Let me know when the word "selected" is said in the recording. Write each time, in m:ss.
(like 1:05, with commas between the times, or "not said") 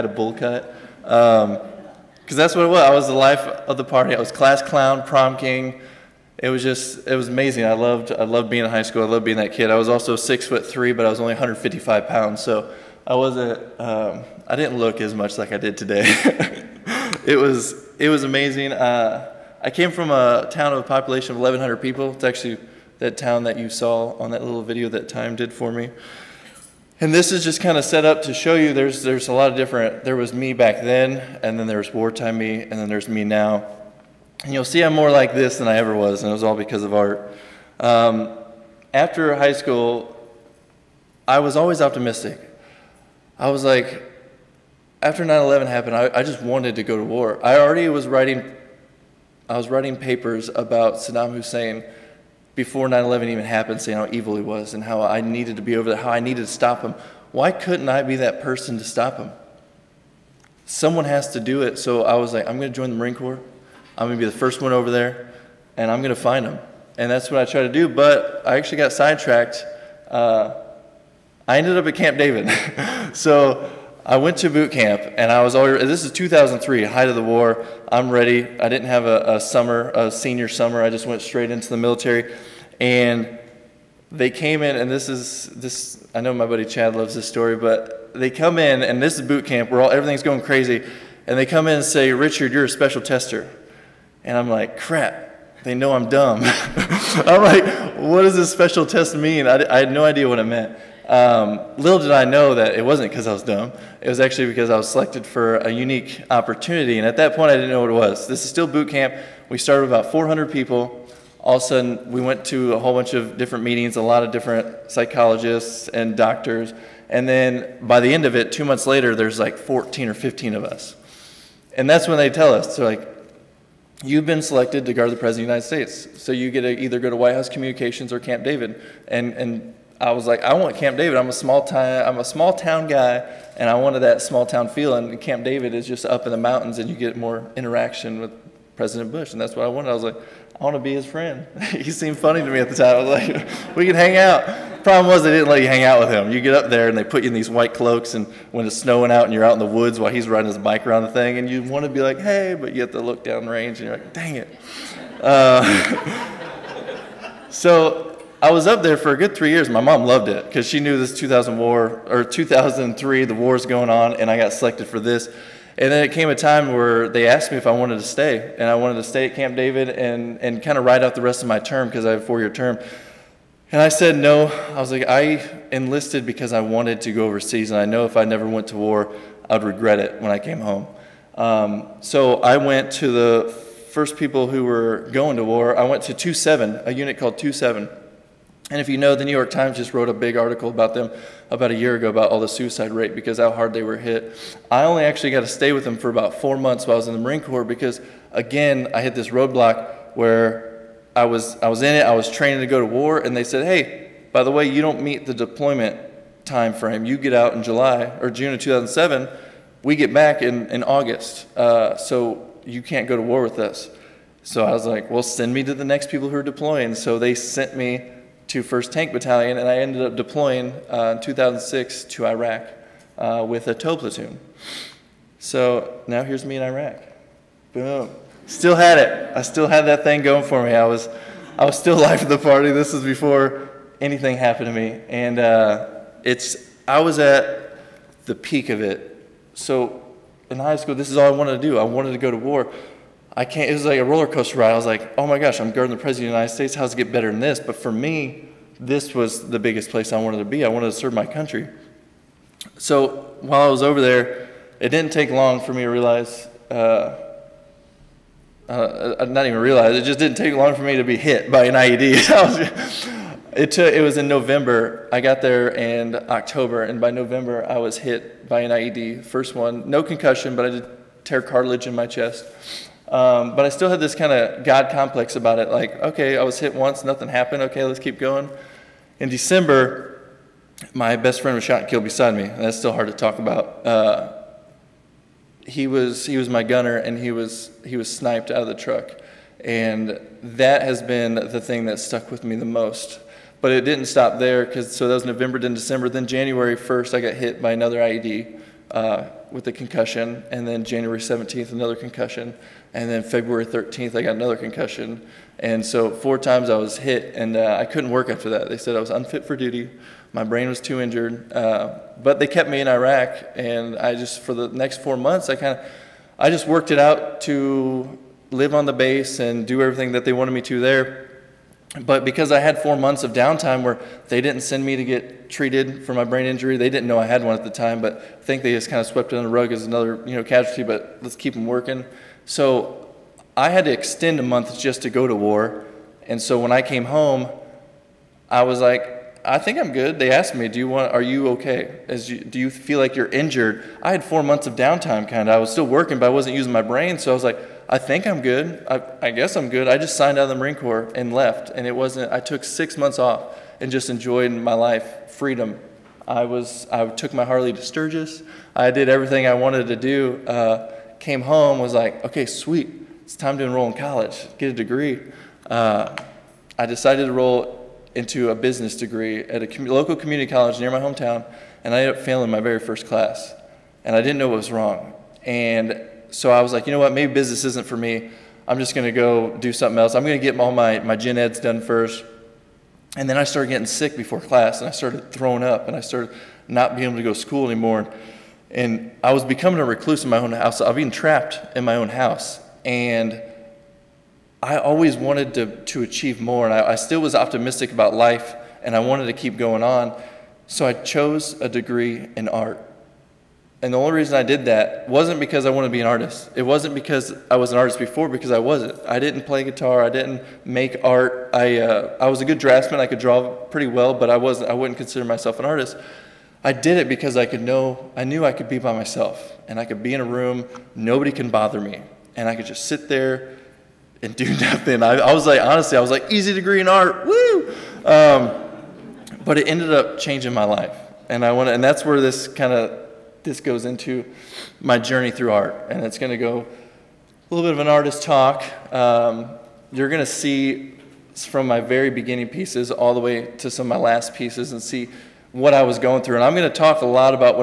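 1:44, 2:04, 2:44.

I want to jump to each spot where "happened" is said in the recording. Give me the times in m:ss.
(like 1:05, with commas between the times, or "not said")
0:45, 0:53, 3:54, 4:37.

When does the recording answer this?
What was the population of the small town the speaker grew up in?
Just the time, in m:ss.
0:21.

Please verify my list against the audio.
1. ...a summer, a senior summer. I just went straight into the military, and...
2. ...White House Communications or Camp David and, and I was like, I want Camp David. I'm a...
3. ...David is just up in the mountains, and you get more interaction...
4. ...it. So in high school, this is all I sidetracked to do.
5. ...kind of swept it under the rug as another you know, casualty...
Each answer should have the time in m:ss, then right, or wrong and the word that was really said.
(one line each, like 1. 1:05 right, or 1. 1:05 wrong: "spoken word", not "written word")
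1. 1:19 right
2. 2:07 right
3. 2:15 right
4. 3:58 wrong: "wanted", not "sidetracked"
5. 5:28 right.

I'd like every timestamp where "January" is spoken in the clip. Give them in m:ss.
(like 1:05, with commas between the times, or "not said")
4:56, 5:00.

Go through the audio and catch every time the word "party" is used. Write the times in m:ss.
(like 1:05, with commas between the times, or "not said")
0:03, 3:52.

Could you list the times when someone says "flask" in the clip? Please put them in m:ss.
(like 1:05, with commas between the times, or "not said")
not said.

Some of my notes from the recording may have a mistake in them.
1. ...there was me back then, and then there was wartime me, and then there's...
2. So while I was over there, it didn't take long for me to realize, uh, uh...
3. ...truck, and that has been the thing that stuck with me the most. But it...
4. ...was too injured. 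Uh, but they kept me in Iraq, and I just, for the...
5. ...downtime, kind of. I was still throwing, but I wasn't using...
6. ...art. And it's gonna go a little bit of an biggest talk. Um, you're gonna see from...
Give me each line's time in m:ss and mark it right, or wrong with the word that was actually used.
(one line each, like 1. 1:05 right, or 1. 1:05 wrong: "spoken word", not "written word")
1. 0:30 right
2. 4:12 right
3. 4:48 right
4. 5:10 right
5. 5:44 wrong: "working", not "throwing"
6. 7:15 wrong: "artist", not "biggest".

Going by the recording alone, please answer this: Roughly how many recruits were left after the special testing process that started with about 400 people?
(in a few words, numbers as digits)
14 or 15.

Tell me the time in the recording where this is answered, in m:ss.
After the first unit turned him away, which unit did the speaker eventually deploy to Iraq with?
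3:38.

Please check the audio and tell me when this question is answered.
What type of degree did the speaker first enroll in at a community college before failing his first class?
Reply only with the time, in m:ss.
6:08.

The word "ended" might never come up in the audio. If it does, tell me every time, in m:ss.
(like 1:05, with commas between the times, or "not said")
1:11, 3:39, 6:12, 7:09.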